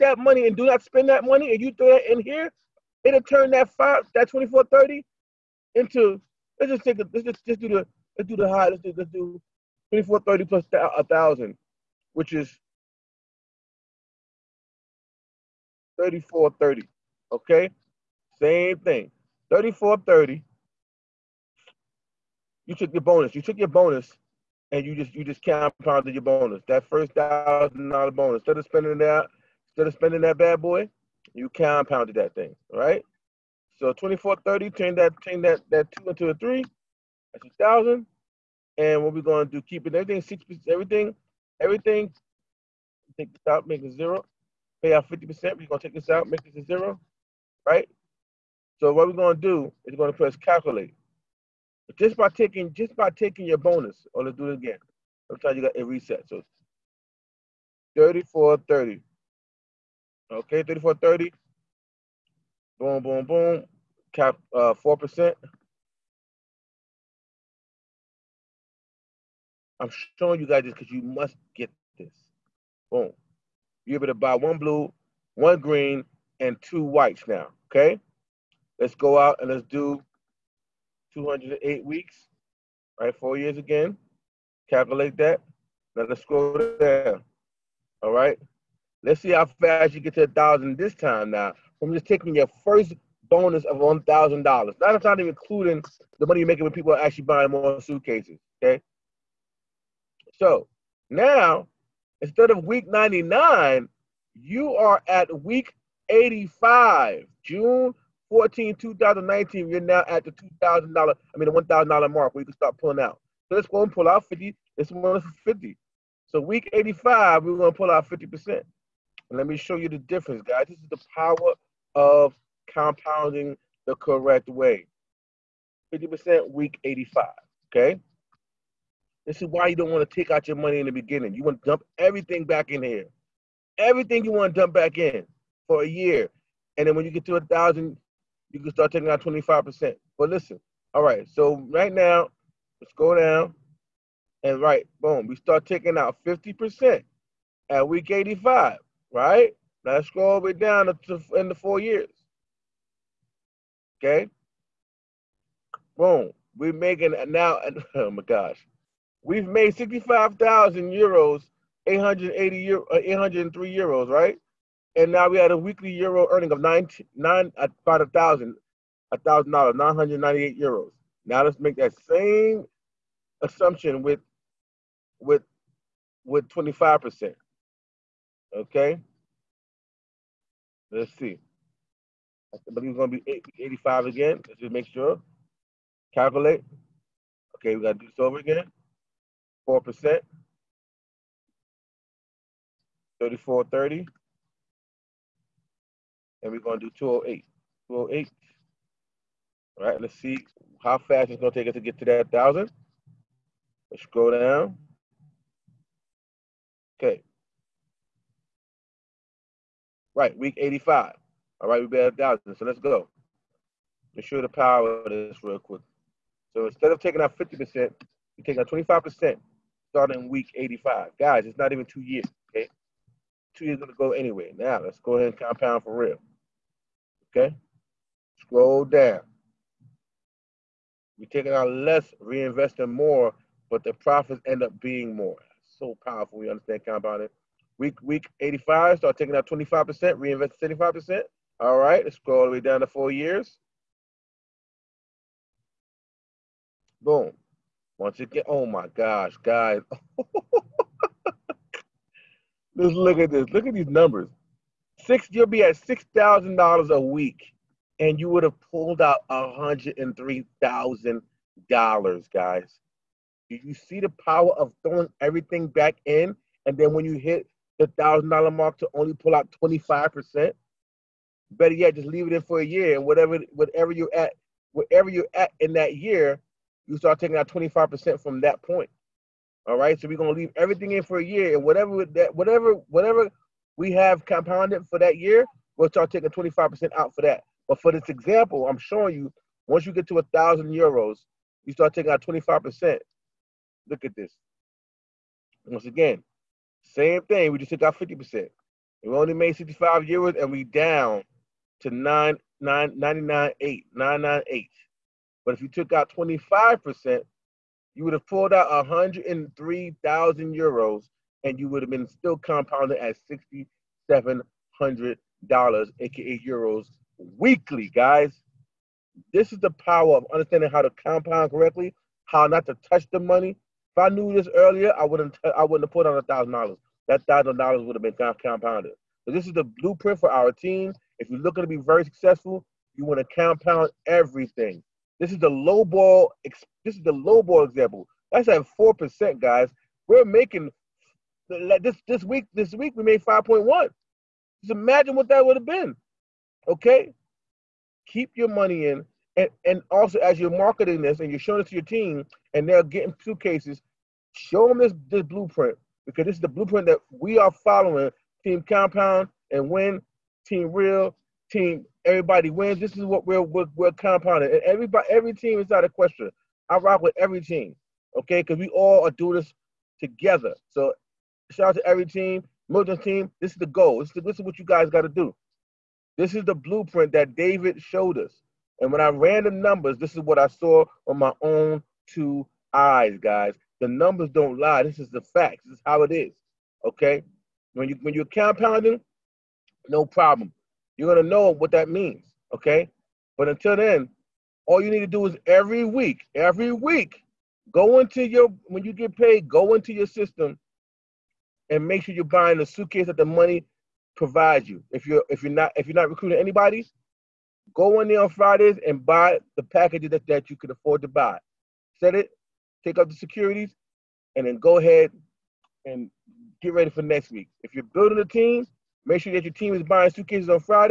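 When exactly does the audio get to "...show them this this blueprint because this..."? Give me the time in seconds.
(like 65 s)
354 s.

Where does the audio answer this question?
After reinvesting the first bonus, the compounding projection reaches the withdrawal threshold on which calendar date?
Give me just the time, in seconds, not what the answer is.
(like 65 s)
107 s.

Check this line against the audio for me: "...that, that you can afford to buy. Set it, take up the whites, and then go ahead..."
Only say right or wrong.
wrong.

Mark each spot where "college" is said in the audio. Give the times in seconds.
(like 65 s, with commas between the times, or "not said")
not said.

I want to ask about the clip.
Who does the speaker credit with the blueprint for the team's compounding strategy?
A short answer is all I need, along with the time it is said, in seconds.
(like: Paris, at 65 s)
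David, at 377 s.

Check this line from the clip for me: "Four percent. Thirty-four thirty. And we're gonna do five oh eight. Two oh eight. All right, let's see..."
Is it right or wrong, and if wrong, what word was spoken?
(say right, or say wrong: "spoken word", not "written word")
wrong: "two", not "five".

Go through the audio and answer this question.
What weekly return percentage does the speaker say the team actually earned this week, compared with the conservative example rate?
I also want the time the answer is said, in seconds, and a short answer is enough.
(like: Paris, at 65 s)
5.1%, at 343 s.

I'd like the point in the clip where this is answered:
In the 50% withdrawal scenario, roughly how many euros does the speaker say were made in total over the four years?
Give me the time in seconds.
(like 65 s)
159 s.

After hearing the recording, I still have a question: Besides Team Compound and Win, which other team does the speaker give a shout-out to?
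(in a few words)
Milton team.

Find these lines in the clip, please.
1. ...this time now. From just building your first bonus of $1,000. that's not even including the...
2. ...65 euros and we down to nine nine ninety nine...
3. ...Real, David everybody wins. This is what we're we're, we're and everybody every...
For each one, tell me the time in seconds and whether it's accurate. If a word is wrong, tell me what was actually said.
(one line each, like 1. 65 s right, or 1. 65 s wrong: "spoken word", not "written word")
1. 90 s wrong: "taking", not "building"
2. 299 s right
3. 360 s wrong: "Team", not "David".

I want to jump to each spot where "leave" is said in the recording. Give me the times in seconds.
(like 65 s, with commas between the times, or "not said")
272 s, 280 s.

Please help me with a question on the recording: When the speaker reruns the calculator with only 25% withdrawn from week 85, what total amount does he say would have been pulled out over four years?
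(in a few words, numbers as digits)
103,000.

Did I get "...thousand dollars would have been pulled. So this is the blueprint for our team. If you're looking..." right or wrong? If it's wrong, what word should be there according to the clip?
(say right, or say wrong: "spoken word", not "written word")
wrong: "compounded", not "pulled".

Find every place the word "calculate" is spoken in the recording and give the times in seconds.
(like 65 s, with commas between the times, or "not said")
50 s, 84 s, 186 s.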